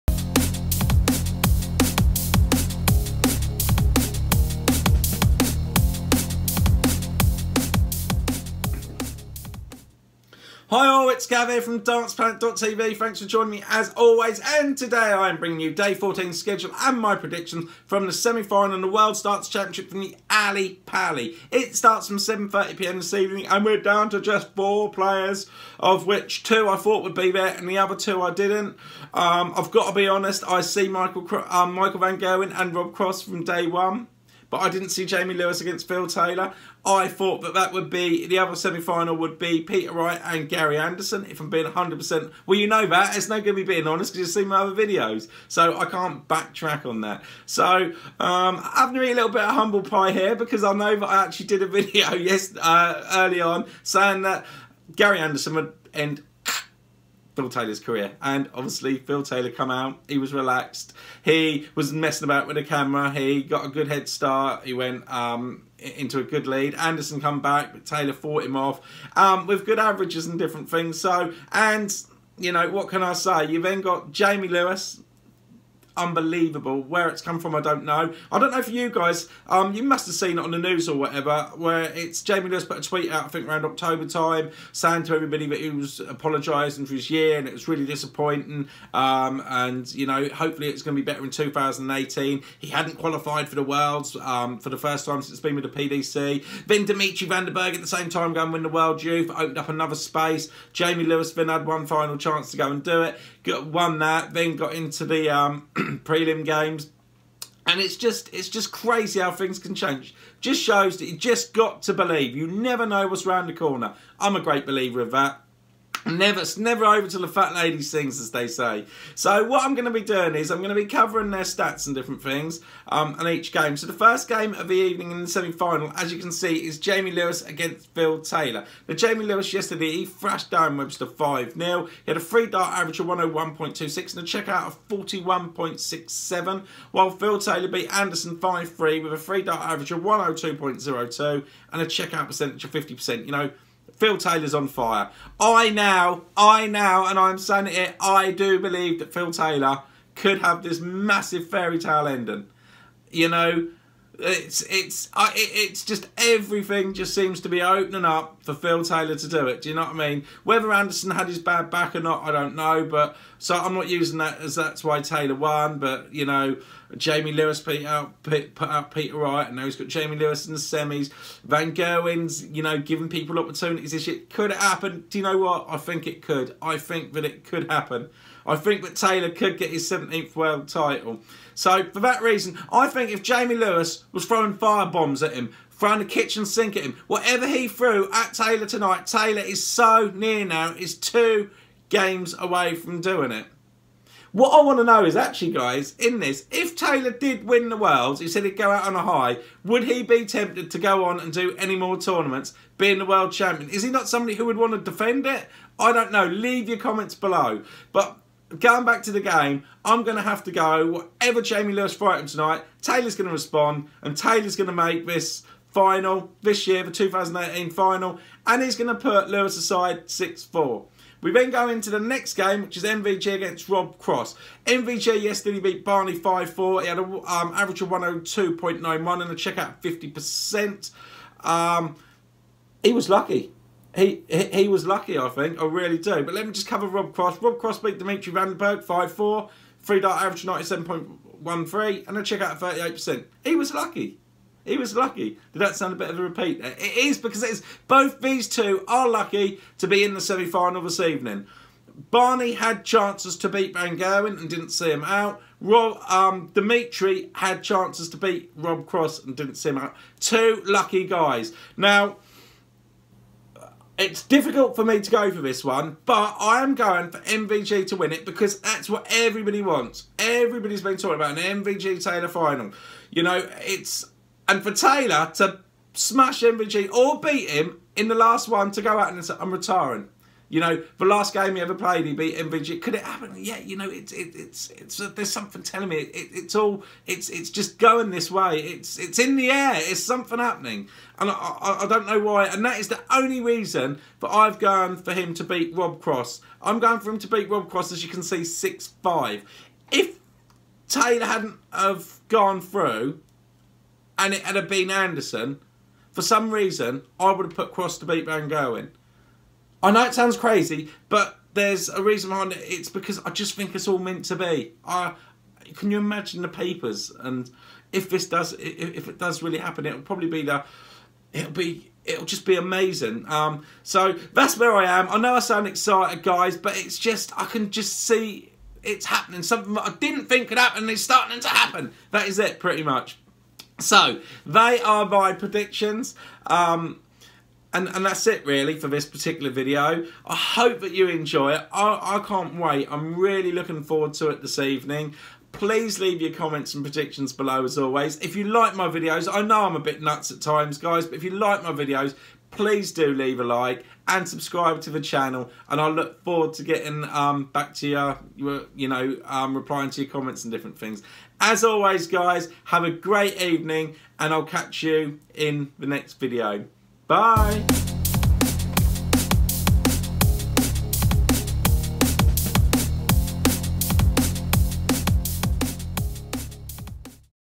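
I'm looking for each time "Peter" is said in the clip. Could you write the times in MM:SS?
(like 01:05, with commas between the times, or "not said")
00:39, 02:48.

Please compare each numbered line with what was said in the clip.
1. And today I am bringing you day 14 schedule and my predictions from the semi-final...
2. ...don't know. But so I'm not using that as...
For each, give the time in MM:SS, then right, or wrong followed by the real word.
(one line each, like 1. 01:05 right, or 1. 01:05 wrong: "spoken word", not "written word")
1. 00:14 right
2. 02:42 right.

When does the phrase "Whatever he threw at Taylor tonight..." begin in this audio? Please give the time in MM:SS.
03:07.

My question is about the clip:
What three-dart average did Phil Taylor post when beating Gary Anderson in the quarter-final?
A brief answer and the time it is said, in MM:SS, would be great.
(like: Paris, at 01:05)
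102.02, at 02:20.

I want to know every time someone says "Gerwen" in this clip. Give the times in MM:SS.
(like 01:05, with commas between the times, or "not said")
00:32, 02:51, 04:13, 05:08.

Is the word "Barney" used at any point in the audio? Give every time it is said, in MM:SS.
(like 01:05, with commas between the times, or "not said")
03:45, 04:12.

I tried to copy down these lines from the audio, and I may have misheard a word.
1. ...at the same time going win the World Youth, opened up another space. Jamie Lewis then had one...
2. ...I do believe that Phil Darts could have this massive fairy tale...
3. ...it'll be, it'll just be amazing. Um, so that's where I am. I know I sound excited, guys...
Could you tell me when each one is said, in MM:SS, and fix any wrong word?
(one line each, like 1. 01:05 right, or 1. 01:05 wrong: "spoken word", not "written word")
1. 01:37 right
2. 02:28 wrong: "Taylor", not "Darts"
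3. 05:21 right.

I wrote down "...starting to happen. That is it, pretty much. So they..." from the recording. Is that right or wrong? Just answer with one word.
right.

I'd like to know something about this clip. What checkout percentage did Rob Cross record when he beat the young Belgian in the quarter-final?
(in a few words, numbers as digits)
38%.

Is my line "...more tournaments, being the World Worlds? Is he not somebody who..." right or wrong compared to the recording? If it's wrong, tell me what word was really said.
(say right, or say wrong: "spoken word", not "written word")
wrong: "Champion", not "Worlds".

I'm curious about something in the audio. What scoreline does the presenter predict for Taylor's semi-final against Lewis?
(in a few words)
6-4.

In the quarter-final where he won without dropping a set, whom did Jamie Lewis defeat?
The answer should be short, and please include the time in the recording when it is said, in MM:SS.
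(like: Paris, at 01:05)
Darren Webster, at 02:10.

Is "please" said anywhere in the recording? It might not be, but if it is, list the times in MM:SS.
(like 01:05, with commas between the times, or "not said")
05:45, 05:52.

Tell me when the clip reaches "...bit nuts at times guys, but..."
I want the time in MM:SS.
05:49.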